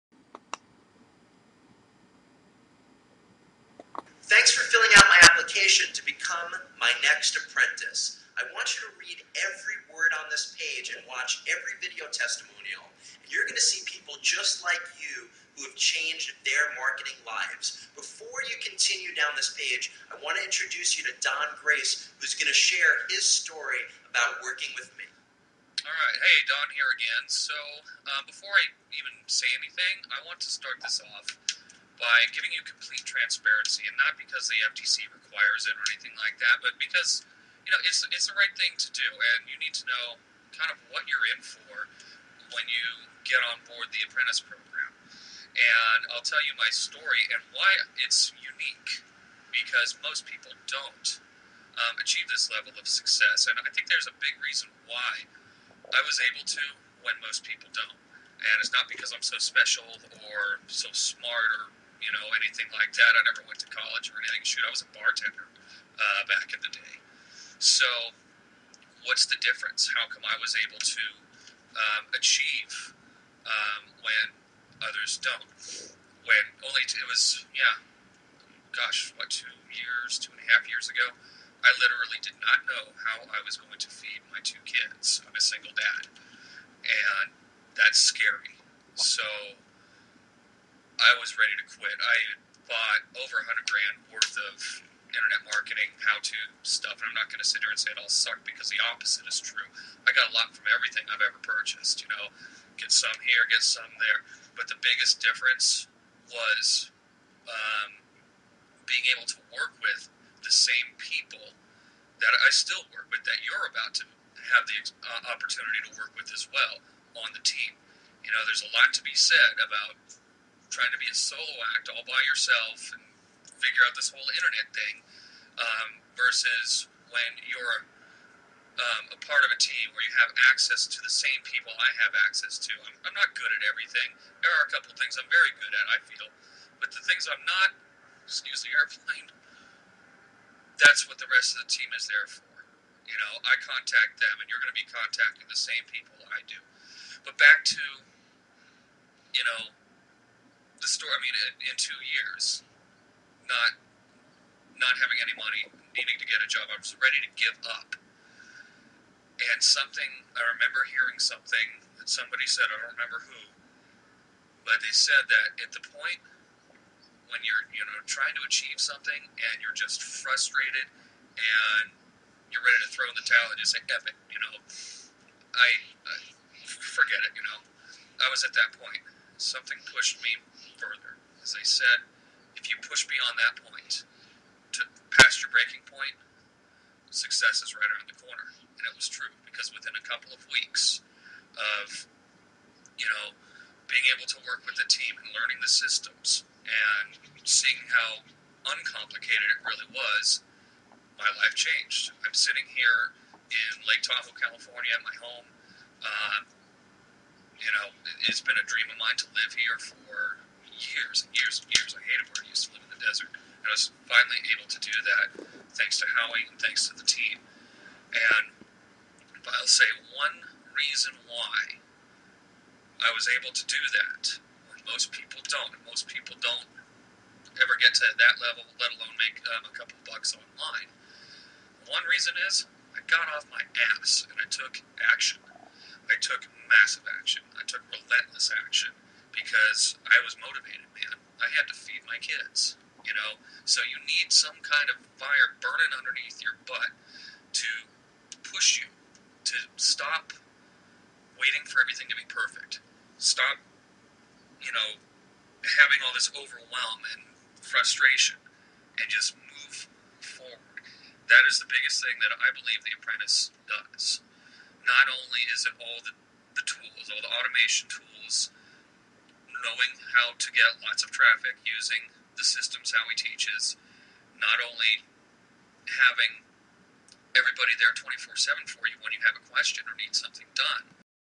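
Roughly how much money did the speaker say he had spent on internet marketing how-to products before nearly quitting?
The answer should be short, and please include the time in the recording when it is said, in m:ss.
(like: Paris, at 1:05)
Over $100,000, at 1:33.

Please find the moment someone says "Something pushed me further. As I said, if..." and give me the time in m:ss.
2:59.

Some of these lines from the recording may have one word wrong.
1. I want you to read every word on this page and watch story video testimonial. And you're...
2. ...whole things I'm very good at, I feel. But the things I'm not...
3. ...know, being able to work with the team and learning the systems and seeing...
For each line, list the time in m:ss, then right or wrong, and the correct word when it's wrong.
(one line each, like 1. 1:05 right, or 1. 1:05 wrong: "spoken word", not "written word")
1. 0:08 wrong: "every", not "story"
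2. 2:14 wrong: "couple", not "whole"
3. 3:13 right.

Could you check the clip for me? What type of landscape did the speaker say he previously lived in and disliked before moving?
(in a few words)
The desert.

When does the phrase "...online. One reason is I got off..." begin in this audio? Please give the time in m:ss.
3:50.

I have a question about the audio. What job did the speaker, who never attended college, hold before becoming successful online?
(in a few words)
Bartender.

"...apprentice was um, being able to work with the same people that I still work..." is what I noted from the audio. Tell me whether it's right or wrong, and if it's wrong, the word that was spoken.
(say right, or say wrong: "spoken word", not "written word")
wrong: "difference", not "apprentice".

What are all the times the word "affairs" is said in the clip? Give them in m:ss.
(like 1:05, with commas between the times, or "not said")
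not said.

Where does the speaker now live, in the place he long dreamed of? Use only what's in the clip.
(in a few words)
Lake Tahoe, California.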